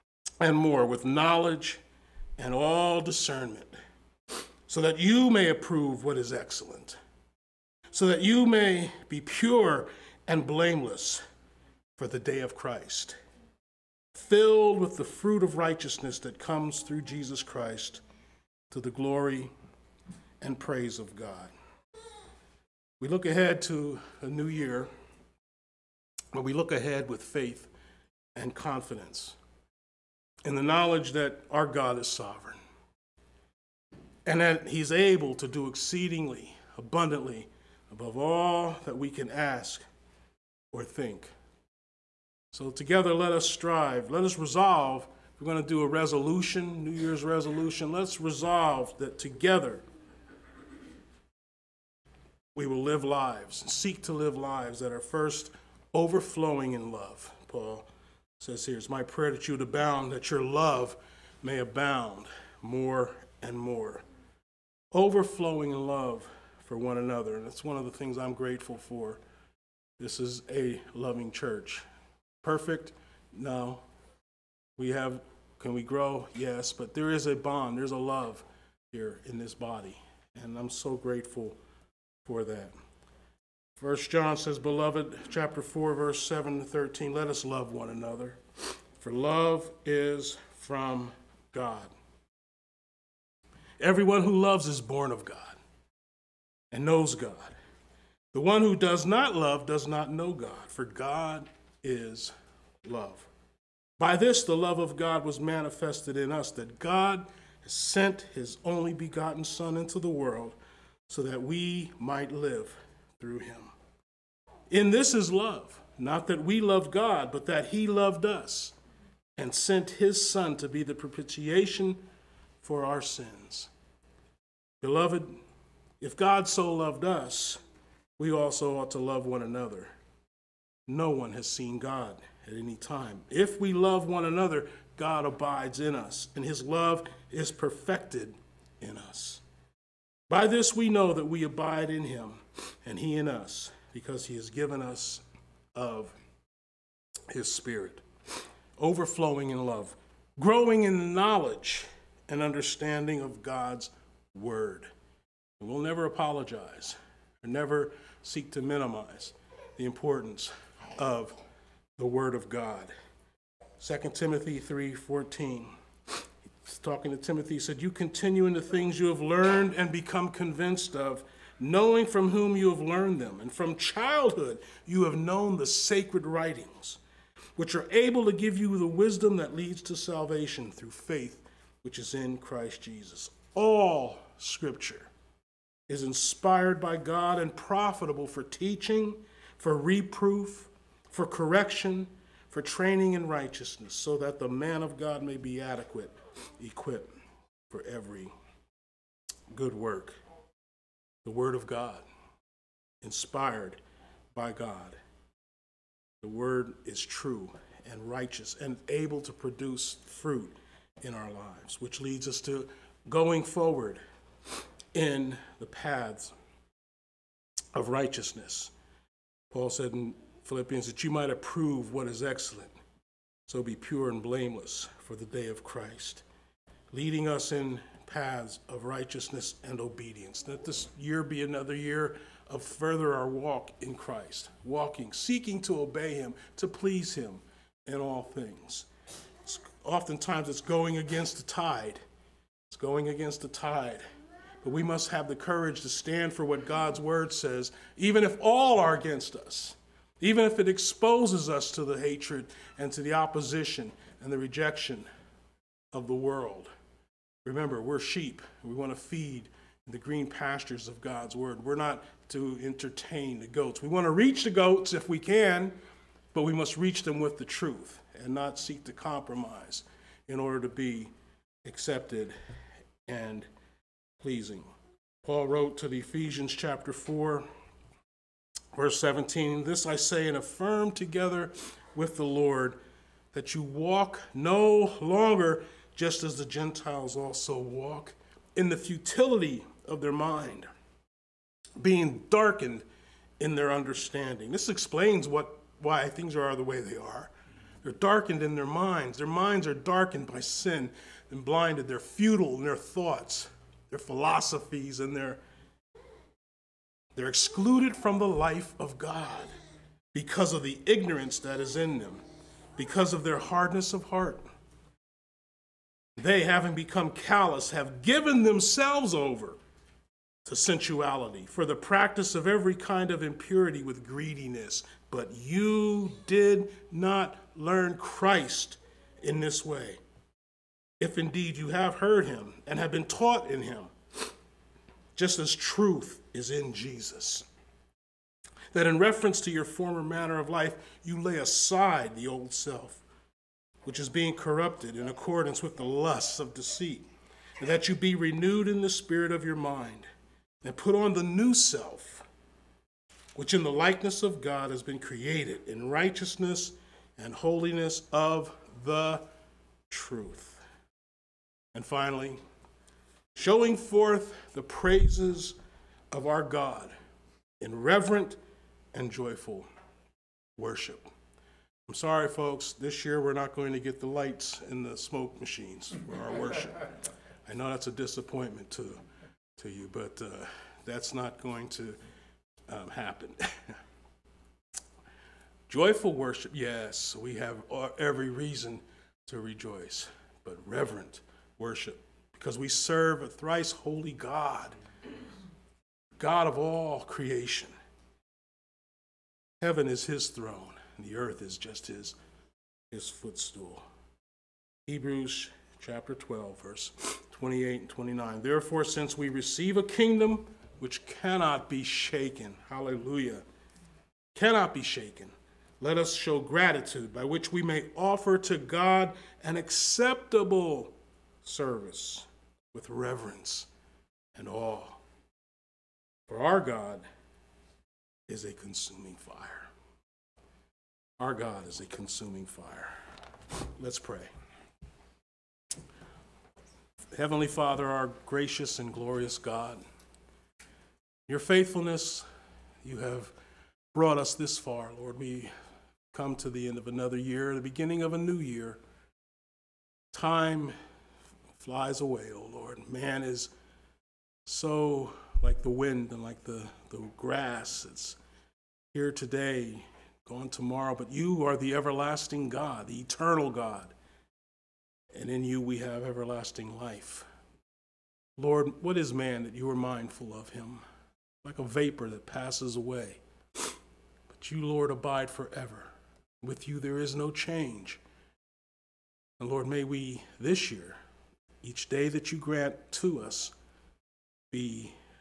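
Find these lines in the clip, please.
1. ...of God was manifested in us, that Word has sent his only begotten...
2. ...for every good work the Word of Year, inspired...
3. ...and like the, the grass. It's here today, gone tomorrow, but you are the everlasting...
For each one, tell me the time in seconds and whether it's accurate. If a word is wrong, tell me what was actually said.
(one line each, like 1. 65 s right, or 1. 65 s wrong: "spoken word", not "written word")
1. 104 s wrong: "God", not "Word"
2. 197 s wrong: "God", not "Year"
3. 456 s right.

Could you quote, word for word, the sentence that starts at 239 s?
It's, oftentimes it's going against the tide.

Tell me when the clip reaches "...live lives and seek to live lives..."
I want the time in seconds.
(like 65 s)
52 s.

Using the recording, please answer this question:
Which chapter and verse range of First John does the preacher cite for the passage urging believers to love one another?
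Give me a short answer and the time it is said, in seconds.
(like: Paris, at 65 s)
chapter 4, verses 7 to 13, at 85 s.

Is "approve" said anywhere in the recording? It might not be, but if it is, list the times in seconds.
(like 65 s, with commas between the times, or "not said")
5 s, 221 s.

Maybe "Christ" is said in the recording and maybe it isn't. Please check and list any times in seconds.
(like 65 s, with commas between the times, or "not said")
12 s, 17 s, 182 s, 225 s, 233 s, 327 s.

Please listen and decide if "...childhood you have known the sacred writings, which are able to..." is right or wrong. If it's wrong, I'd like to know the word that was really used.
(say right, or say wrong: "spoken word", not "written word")
right.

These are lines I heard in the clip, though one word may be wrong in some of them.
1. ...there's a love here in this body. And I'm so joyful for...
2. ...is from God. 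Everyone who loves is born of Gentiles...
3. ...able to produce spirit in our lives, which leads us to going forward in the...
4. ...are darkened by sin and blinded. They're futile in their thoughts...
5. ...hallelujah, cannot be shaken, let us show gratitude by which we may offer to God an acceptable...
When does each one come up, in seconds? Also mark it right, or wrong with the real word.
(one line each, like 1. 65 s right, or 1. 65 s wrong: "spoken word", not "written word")
1. 77 s wrong: "grateful", not "joyful"
2. 89 s wrong: "God", not "Gentiles"
3. 208 s wrong: "fruit", not "spirit"
4. 299 s right
5. 412 s right.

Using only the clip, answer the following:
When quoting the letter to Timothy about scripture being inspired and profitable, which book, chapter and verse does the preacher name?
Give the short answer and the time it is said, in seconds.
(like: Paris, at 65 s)
2 Timothy 3:14, at 163 s.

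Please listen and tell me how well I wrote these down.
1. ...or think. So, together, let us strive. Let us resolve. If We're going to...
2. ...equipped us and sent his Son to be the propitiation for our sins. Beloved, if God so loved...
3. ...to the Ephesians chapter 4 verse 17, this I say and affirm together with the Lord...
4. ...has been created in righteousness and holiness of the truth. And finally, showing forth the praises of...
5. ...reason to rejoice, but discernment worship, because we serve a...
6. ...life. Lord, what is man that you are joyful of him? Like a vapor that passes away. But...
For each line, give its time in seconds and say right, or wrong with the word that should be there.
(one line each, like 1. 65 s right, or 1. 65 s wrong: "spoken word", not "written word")
1. 40 s right
2. 117 s wrong: "loved", not "equipped"
3. 275 s right
4. 354 s right
5. 388 s wrong: "reverent", not "discernment"
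6. 466 s wrong: "mindful", not "joyful".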